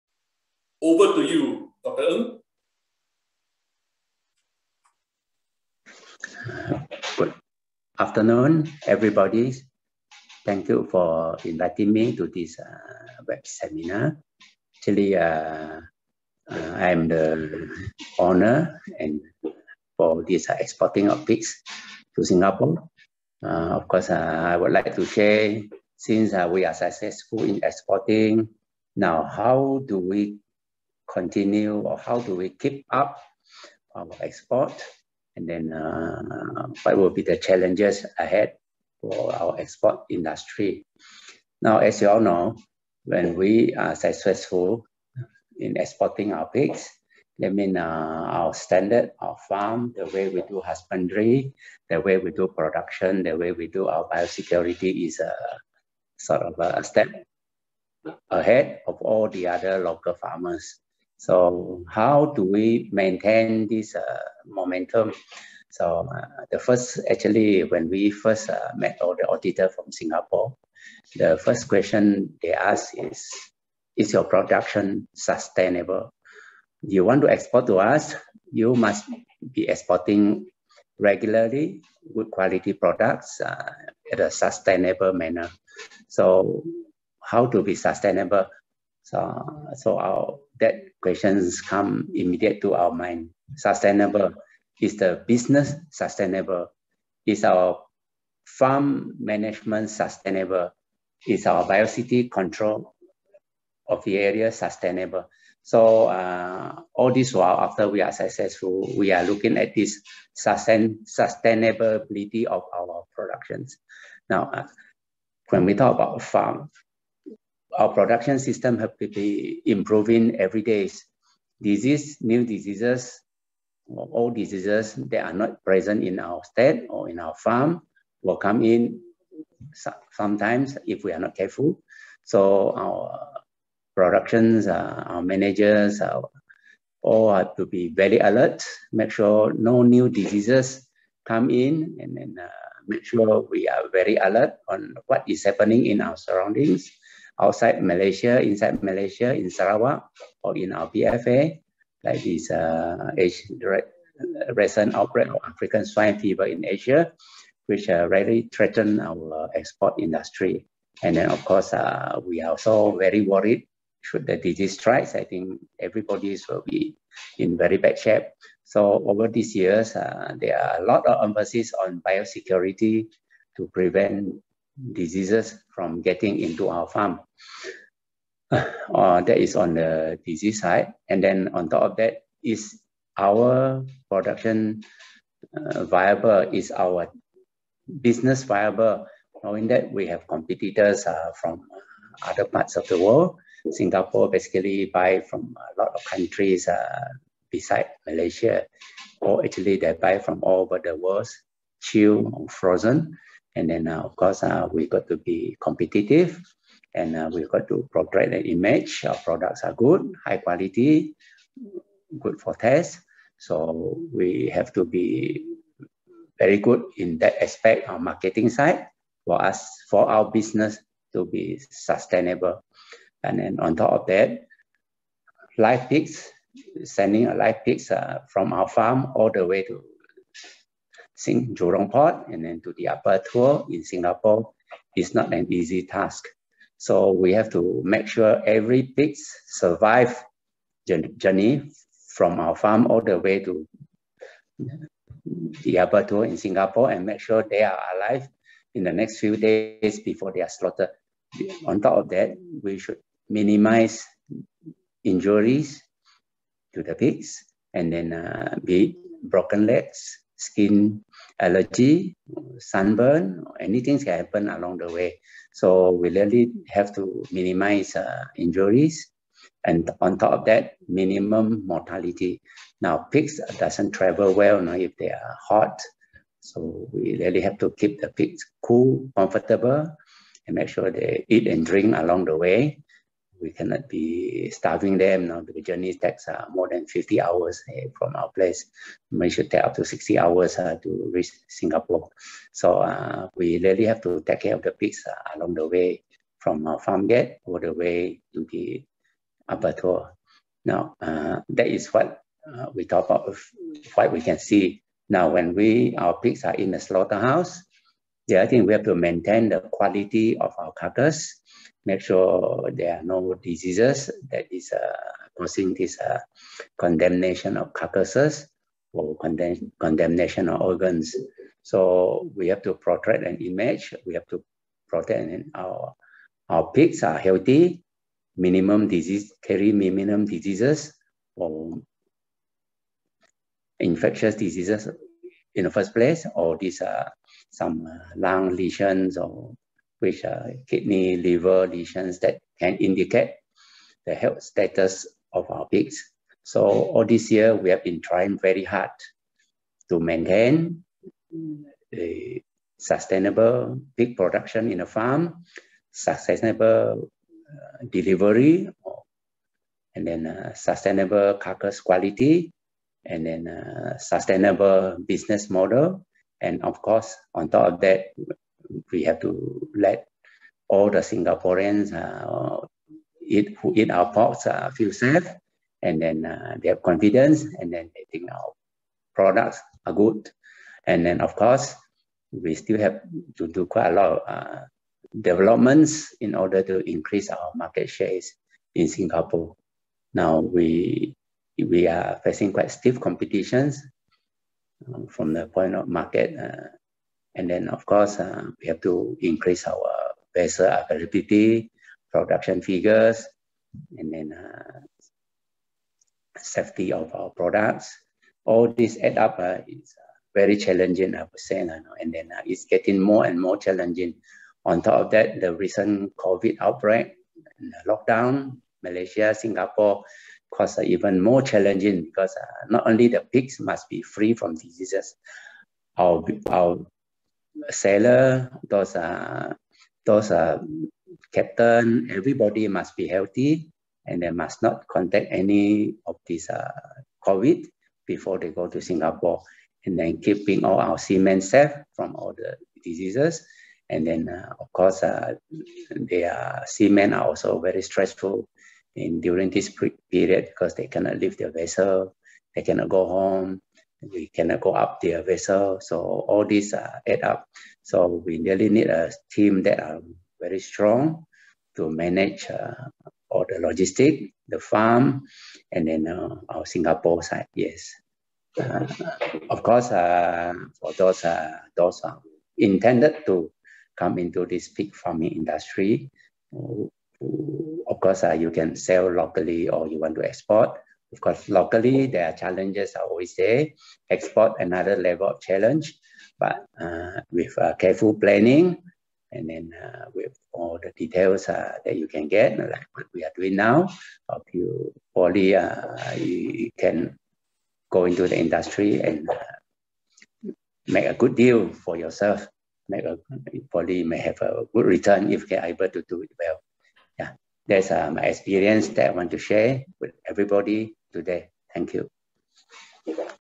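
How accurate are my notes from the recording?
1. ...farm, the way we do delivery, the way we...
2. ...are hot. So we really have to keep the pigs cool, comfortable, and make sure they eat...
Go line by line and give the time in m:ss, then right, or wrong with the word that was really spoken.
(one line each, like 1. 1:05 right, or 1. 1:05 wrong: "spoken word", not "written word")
1. 0:49 wrong: "husbandry", not "delivery"
2. 4:35 right.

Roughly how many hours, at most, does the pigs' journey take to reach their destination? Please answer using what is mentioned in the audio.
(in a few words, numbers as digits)
60 hours.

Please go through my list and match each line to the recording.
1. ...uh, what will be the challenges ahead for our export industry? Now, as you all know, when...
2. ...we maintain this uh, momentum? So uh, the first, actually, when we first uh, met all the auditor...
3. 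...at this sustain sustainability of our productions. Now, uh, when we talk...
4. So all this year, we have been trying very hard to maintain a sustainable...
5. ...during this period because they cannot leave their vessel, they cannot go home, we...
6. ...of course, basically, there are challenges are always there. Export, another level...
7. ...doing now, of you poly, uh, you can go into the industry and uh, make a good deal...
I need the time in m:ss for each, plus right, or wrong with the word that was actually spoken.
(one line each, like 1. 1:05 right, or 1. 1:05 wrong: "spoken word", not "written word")
1. 0:35 right
2. 1:02 right
3. 1:49 right
4. 5:46 right
5. 7:29 right
6. 8:01 wrong: "locally", not "basically"
7. 8:13 right.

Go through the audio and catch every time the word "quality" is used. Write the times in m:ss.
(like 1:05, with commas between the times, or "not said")
1:22, 3:30, 5:09, 6:01.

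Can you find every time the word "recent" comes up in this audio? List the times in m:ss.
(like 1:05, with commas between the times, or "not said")
2:34, 6:55.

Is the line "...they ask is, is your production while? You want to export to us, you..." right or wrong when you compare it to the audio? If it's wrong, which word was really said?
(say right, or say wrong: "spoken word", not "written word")
wrong: "sustainable", not "while".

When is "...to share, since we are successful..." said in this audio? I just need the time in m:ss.
0:24.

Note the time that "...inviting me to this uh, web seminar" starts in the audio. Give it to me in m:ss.
0:11.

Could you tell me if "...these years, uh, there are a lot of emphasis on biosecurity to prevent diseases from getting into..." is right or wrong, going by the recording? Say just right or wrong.
right.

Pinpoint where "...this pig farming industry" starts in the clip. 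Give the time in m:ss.
7:54.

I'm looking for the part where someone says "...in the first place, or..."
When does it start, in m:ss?
5:35.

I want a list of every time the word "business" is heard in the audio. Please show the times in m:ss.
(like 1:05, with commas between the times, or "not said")
1:35, 3:08, 3:40, 6:05.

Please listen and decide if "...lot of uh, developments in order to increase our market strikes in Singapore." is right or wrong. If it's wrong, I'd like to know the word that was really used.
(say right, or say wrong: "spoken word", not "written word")
wrong: "shares", not "strikes".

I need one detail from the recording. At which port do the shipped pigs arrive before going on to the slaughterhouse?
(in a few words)
Jurong Port.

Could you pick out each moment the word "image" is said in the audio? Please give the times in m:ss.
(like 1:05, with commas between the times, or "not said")
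3:28, 5:23.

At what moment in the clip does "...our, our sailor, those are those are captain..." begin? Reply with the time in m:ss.
7:05.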